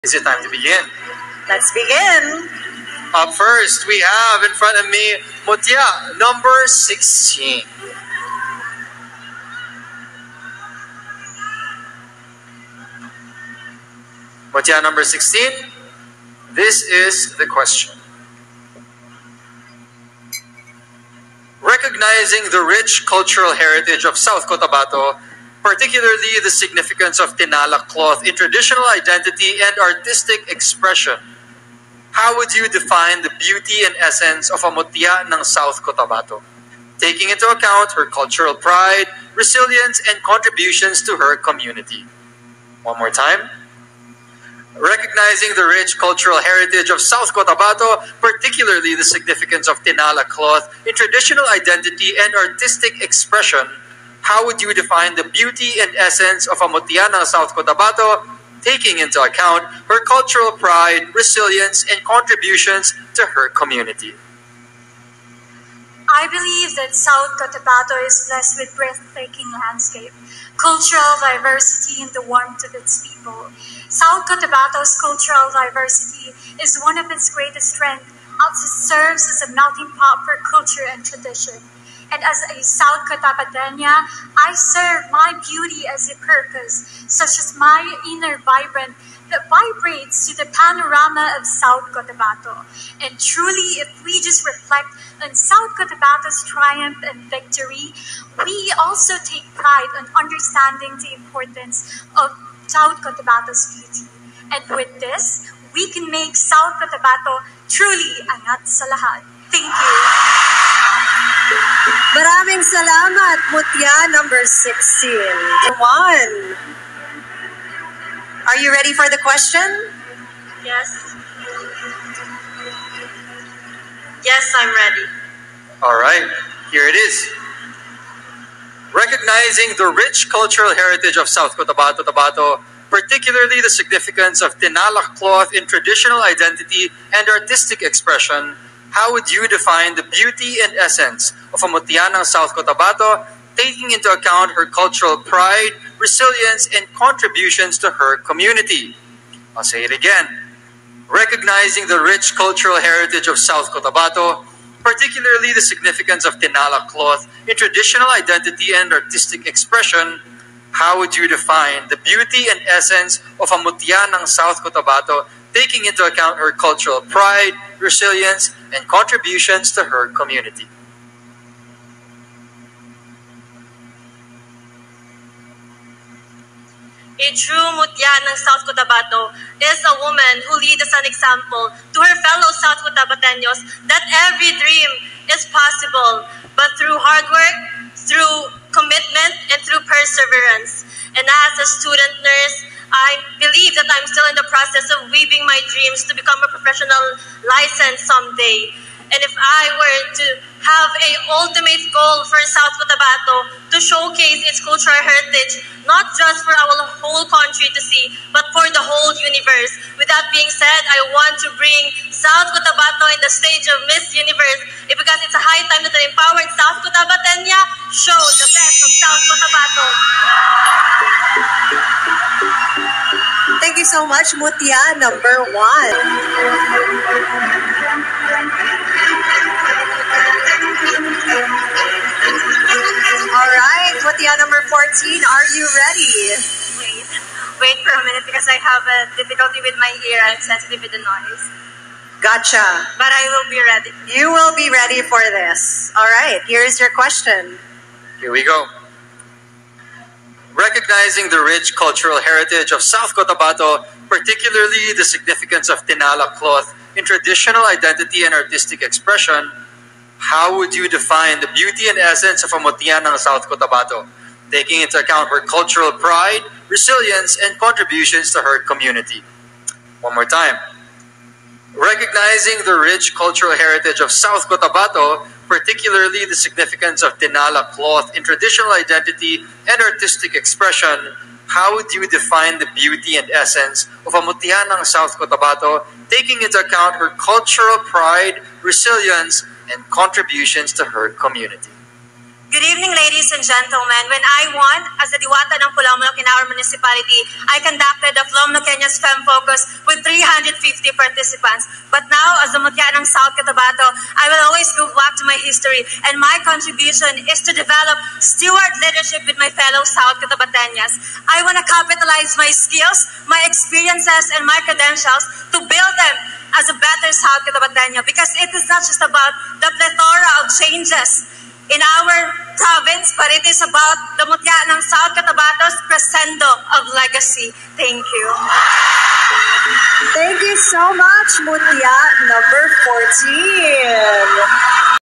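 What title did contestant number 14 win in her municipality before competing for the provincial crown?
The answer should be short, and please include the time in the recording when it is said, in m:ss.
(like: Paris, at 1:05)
Diwata ng Polomolok, at 4:55.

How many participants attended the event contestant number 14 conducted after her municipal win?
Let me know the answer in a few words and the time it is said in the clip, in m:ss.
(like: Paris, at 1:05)
350, at 5:00.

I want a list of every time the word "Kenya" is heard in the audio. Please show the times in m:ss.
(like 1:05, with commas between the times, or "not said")
4:58.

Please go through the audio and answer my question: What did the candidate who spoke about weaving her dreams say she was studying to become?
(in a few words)
nurse.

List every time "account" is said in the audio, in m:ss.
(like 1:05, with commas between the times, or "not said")
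0:37, 0:59, 2:24, 2:46, 4:24, 4:46.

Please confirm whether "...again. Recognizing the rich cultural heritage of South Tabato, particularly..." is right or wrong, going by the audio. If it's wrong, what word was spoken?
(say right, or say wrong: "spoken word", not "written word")
wrong: "Cotabato", not "Tabato".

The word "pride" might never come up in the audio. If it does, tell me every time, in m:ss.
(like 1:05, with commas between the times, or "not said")
0:38, 1:00, 1:39, 2:25, 2:47, 4:25, 4:47.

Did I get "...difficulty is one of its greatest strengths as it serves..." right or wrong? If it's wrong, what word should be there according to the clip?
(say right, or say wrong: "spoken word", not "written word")
wrong: "diversity", not "difficulty".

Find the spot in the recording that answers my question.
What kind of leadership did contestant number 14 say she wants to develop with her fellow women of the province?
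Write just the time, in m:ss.
5:08.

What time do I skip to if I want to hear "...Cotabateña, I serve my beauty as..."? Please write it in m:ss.
1:23.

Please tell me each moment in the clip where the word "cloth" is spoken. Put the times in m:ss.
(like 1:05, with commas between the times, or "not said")
0:27, 0:50, 2:15, 2:36, 4:16, 4:37.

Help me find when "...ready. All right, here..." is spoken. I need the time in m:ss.
2:04.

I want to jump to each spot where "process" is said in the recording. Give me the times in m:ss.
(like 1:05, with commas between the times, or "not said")
3:14.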